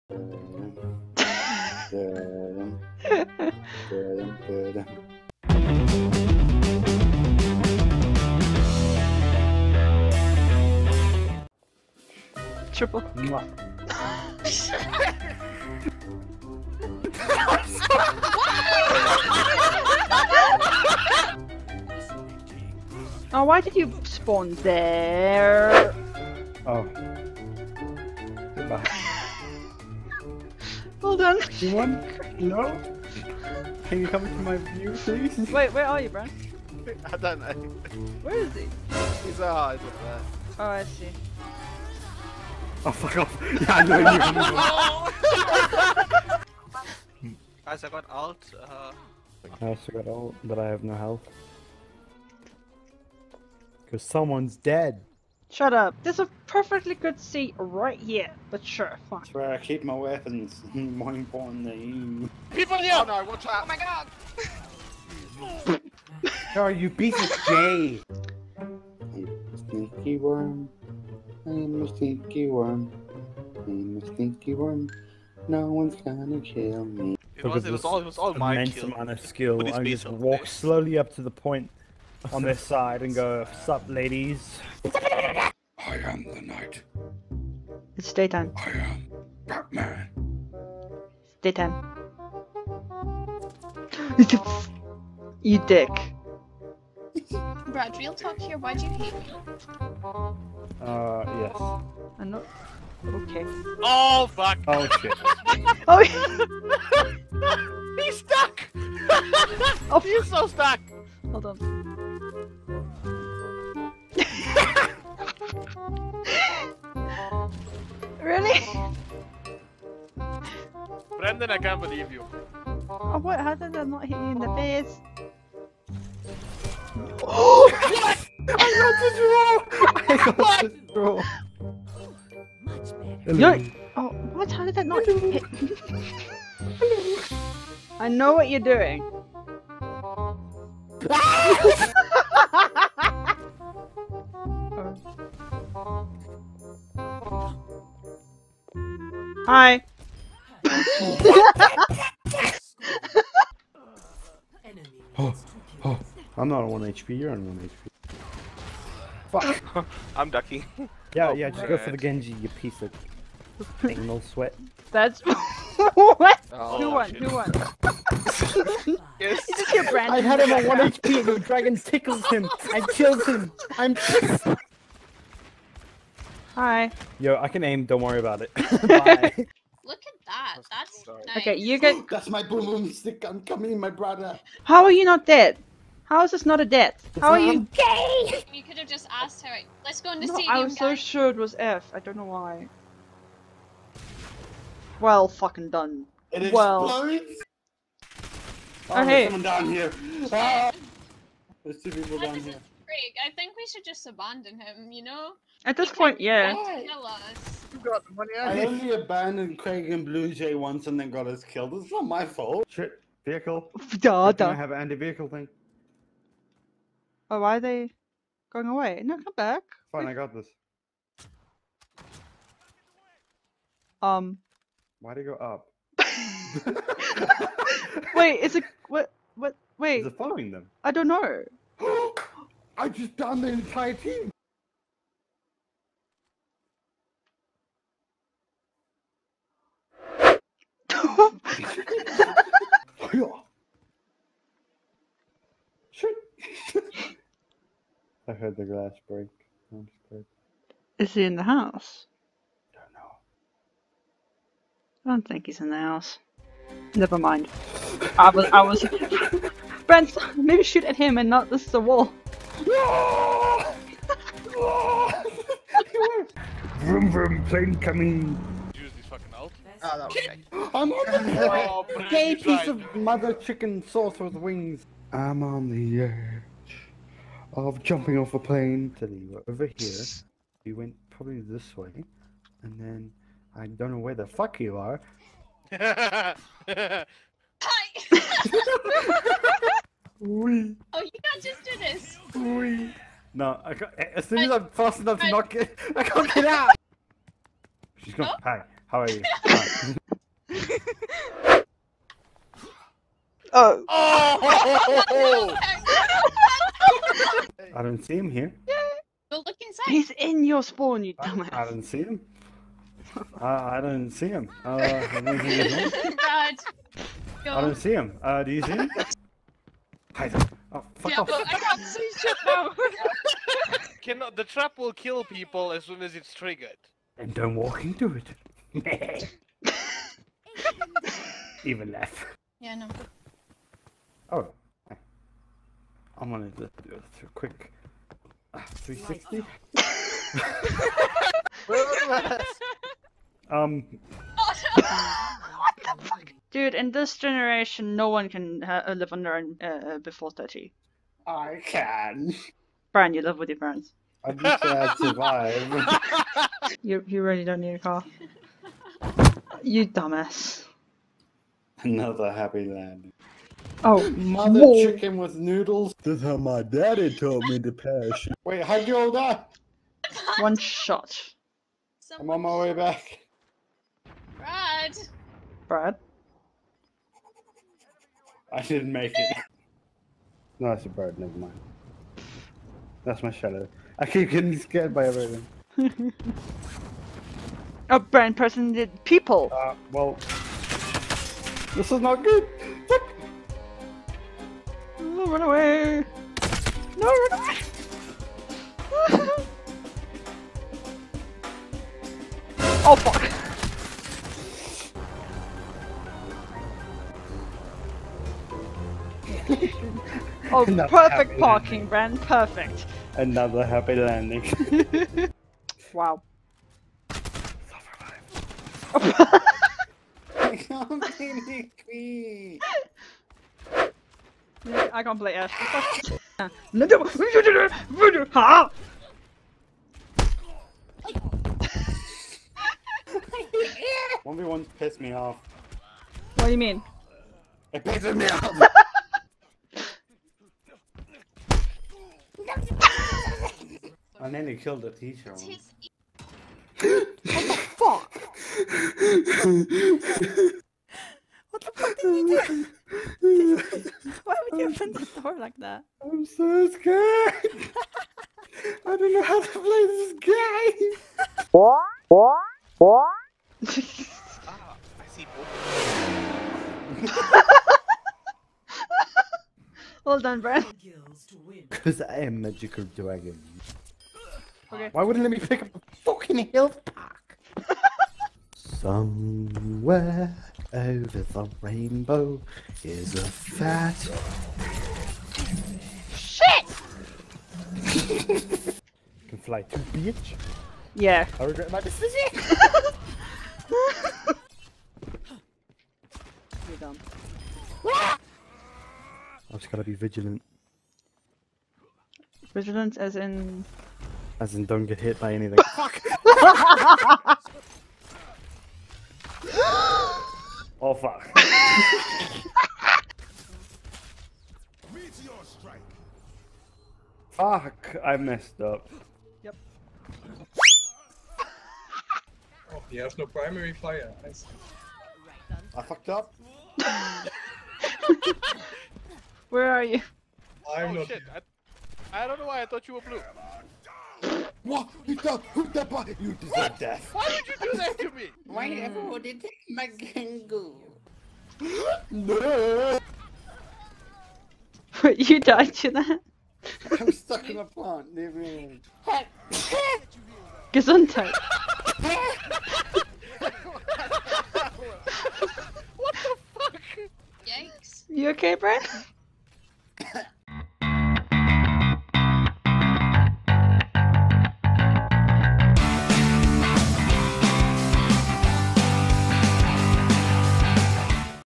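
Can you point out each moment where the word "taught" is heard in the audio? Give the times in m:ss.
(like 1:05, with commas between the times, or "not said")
6:07.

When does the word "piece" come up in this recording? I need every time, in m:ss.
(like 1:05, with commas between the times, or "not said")
2:42, 4:32.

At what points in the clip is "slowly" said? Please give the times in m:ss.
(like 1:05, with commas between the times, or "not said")
1:20.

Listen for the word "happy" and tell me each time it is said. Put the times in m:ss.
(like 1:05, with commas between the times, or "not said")
6:02, 6:53.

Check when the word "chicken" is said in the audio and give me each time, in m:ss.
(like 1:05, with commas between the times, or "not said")
4:33, 6:04.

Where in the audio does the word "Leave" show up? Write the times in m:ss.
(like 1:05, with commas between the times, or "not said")
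9:08.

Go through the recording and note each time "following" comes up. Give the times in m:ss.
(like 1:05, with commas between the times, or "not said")
3:50.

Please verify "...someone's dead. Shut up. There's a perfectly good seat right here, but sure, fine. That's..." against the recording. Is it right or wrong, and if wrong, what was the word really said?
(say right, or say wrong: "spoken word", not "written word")
right.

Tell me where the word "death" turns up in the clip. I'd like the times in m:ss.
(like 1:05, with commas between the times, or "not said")
3:06, 8:56.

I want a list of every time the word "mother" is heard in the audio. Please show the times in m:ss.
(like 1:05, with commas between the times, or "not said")
4:32, 6:04.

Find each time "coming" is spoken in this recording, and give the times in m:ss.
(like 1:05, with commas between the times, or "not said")
3:03, 4:27.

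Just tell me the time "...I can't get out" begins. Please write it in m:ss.
4:55.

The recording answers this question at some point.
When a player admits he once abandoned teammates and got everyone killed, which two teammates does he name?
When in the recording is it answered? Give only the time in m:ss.
3:29.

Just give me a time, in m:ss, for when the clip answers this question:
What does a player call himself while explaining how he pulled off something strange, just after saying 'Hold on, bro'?
7:52.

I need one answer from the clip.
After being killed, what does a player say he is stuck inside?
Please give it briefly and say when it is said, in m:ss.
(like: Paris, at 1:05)
a plant, at 9:07.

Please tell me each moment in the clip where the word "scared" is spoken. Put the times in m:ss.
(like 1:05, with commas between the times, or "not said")
4:10, 6:24, 7:36.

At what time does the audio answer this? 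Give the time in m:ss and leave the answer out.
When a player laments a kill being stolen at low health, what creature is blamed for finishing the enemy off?
2:51.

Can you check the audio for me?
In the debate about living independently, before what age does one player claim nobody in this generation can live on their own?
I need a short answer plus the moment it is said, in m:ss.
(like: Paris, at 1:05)
30, at 5:49.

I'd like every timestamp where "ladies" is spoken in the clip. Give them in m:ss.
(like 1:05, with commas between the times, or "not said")
1:23.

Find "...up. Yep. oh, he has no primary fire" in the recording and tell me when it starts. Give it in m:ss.
8:38.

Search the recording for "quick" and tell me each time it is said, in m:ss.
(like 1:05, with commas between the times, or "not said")
5:37.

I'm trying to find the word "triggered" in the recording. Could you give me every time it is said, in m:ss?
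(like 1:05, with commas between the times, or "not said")
5:26.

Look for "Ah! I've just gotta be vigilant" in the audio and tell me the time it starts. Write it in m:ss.
8:17.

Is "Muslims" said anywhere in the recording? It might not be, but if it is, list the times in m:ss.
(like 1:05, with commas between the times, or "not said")
not said.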